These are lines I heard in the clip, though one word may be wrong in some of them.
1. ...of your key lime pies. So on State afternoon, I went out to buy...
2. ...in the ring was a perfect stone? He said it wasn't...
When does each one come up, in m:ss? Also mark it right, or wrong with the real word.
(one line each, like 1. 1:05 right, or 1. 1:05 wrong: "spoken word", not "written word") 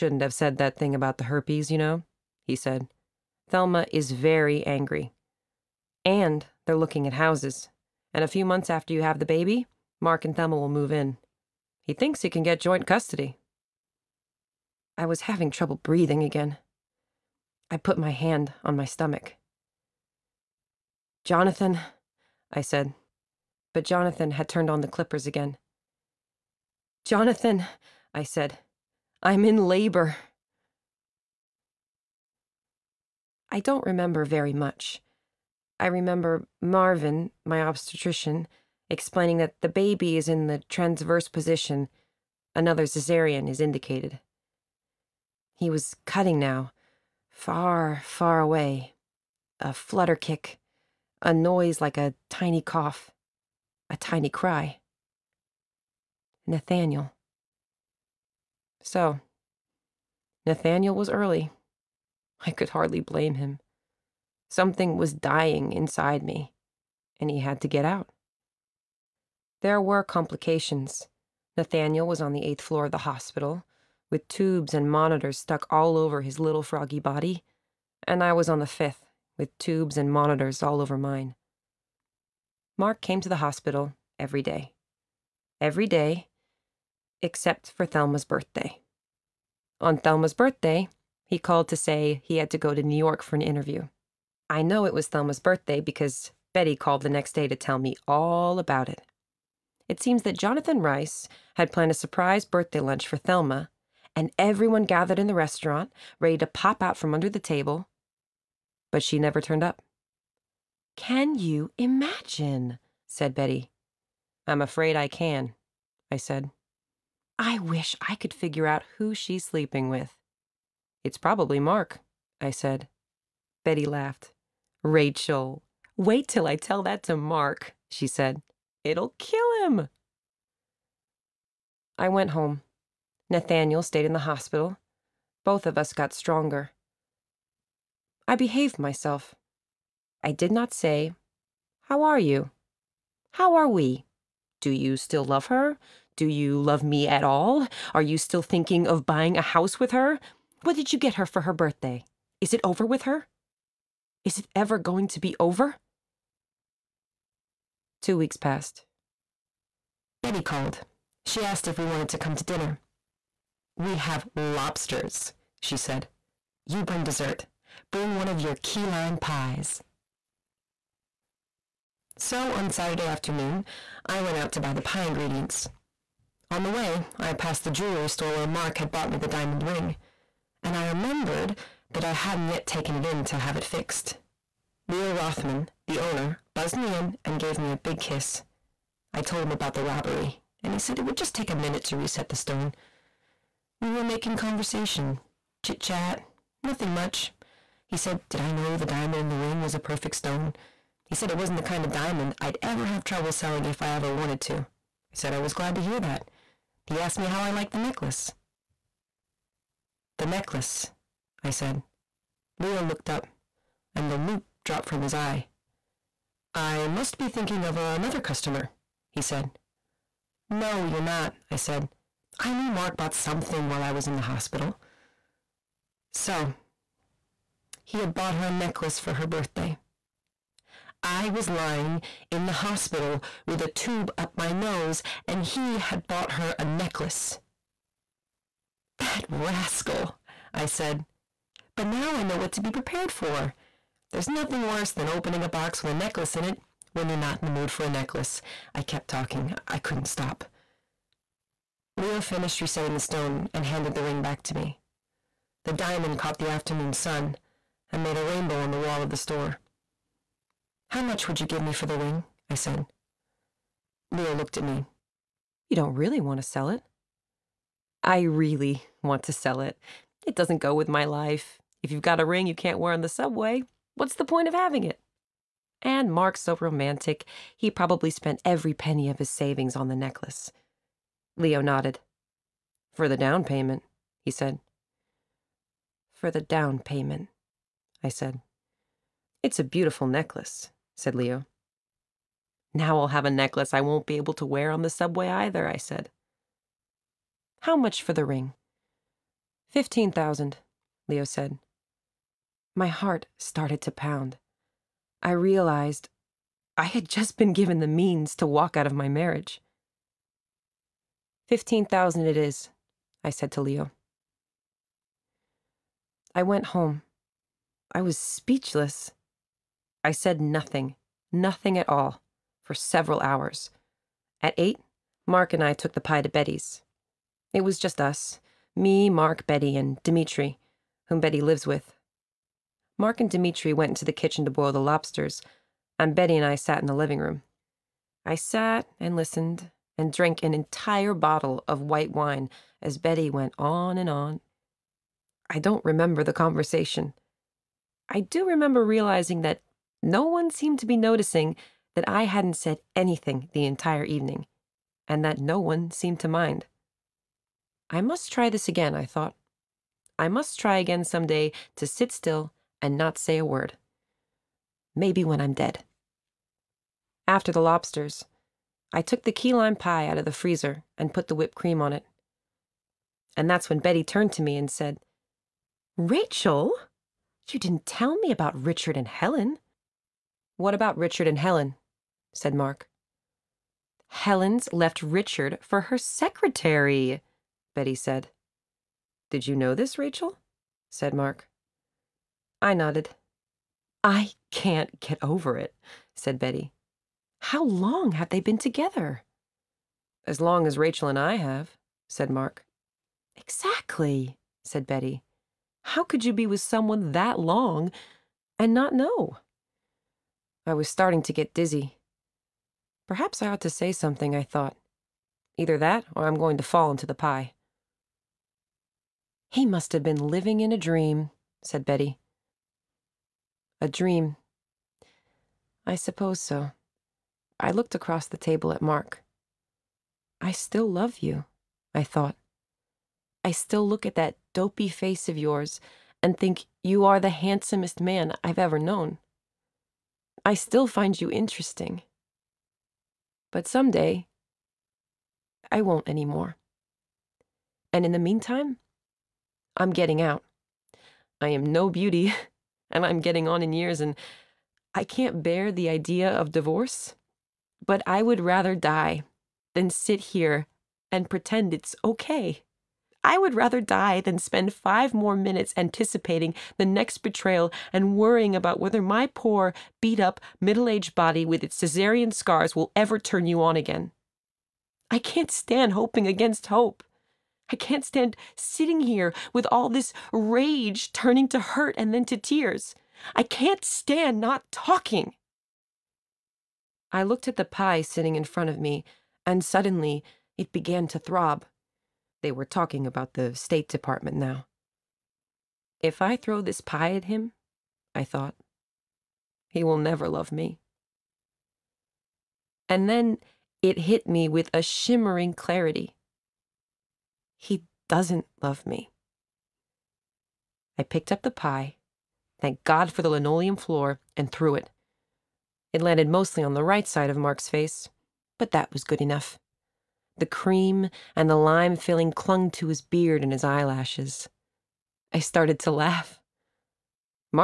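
1. 2:48 wrong: "Saturday", not "State"
2. 3:19 right.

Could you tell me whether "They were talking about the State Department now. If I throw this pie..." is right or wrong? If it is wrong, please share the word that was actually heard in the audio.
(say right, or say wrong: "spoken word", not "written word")
right.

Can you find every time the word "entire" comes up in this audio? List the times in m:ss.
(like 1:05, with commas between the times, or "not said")
5:40, 5:53.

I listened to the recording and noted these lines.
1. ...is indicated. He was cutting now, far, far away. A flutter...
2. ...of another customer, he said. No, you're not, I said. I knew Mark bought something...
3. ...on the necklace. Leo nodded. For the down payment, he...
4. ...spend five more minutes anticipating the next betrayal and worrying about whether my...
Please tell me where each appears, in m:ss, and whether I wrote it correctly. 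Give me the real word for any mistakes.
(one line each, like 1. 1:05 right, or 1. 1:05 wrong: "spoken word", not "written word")
1. 0:43 right
2. 3:37 right
3. 4:39 right
4. 7:44 right.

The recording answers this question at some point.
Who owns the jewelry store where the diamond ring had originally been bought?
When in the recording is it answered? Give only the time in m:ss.
3:04.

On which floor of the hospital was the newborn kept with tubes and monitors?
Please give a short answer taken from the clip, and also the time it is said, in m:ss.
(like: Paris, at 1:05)
Eighth floor, at 1:12.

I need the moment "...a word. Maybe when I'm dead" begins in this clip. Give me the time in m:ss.
6:03.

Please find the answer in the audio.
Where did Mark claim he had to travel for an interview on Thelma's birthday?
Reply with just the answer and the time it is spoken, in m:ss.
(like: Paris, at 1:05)
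New York, at 1:32.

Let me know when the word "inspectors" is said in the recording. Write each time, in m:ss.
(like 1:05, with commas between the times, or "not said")
not said.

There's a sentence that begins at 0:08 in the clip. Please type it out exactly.
And a few months after you have the baby, Mark and Thelma will move in.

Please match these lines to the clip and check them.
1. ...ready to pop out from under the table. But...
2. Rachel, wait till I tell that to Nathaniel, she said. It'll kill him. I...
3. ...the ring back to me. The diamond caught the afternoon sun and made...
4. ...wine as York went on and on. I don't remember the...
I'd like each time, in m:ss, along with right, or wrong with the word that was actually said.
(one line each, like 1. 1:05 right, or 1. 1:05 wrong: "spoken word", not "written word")
1. 1:46 right
2. 2:04 wrong: "Mark", not "Nathaniel"
3. 4:13 right
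4. 5:42 wrong: "Betty", not "York".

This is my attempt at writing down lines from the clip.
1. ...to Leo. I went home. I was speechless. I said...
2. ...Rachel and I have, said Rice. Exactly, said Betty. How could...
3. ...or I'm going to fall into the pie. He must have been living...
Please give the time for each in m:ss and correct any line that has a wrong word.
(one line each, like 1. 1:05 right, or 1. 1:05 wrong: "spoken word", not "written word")
1. 5:13 right
2. 6:40 wrong: "Mark", not "Rice"
3. 6:56 right.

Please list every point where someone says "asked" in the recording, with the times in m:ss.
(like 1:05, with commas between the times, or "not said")
2:41, 3:26.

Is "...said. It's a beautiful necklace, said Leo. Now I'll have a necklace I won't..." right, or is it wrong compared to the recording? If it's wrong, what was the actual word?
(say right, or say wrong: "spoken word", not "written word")
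right.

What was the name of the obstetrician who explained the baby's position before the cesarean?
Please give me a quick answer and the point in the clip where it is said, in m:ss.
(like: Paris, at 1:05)
Marvin, at 0:36.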